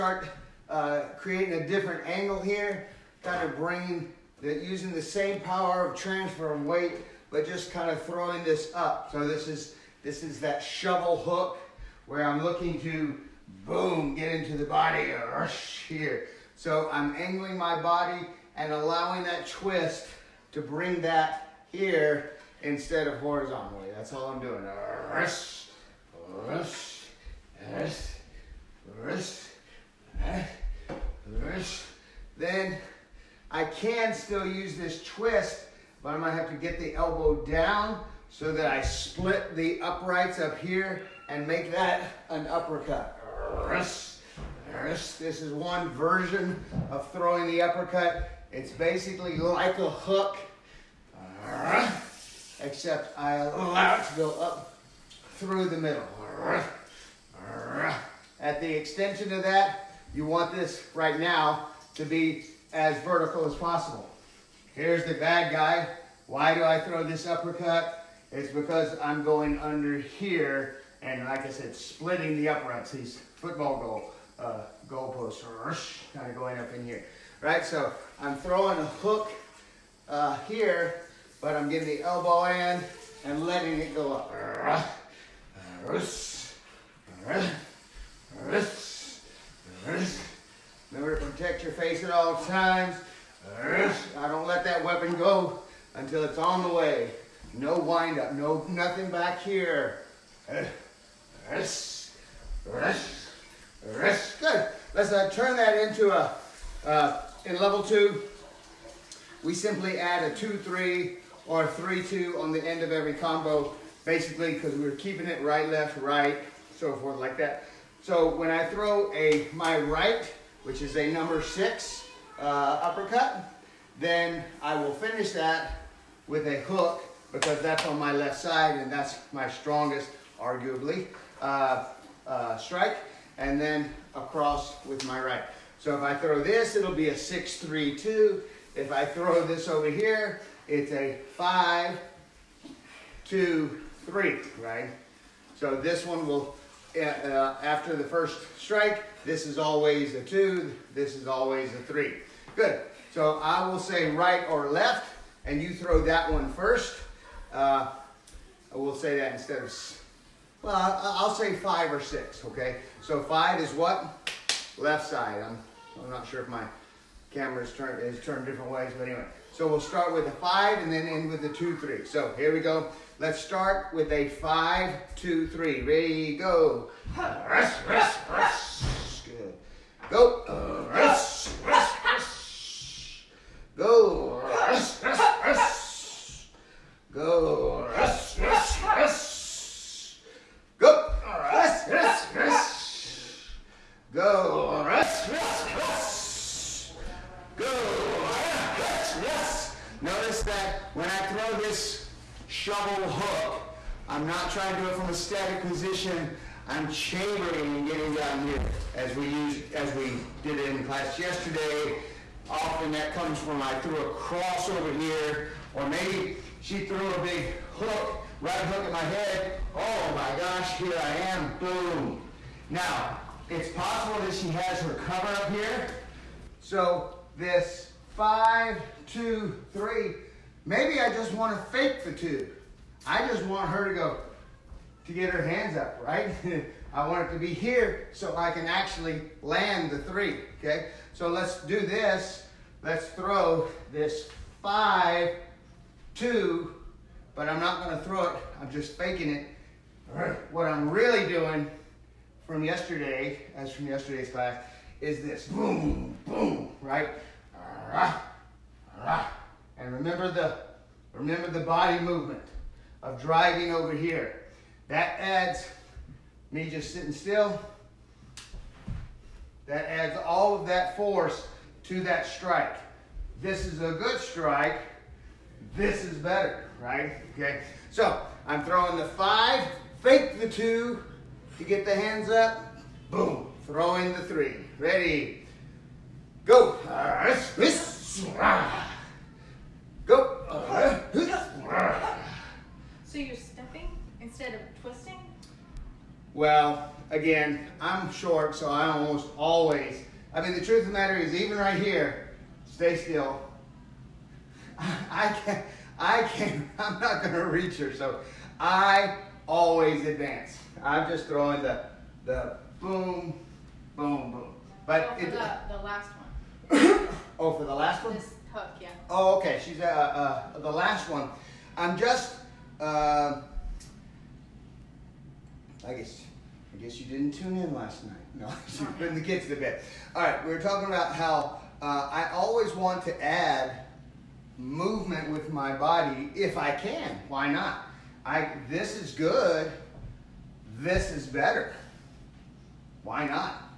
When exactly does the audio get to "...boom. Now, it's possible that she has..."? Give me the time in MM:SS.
03:41.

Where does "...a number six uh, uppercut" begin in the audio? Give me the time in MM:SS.
02:00.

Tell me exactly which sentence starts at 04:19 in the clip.
And remember the, remember the body movement of driving over here.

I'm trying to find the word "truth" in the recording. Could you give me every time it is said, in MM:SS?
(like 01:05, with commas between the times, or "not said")
05:00.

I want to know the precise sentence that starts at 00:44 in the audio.
This is one version of throwing the uppercut.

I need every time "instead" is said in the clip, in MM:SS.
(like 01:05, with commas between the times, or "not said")
00:22, 02:39, 04:54.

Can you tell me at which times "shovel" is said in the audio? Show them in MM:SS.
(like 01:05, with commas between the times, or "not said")
00:10, 03:22.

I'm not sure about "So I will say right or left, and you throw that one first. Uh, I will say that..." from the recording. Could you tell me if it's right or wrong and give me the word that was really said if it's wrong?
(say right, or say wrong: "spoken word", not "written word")
right.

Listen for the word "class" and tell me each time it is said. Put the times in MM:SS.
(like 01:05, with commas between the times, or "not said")
03:30, 04:14.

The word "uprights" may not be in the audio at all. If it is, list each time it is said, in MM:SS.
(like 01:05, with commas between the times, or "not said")
00:39, 01:12.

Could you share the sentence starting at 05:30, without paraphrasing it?
All right, we were talking about how uh, I always want to add movement with my body if I can.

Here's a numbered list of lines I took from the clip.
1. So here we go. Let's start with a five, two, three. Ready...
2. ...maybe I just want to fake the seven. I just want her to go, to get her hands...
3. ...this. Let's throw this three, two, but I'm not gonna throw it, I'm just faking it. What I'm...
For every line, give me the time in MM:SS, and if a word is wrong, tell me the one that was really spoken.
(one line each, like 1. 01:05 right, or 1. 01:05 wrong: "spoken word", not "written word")
1. 02:52 right
2. 03:50 wrong: "two", not "seven"
3. 04:01 wrong: "five", not "three".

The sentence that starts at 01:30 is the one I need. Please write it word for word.
Remember to protect your face at all times.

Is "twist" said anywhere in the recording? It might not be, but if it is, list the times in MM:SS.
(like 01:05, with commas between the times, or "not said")
00:19, 00:35.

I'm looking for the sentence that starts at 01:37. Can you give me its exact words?
No wind up, no nothing back here.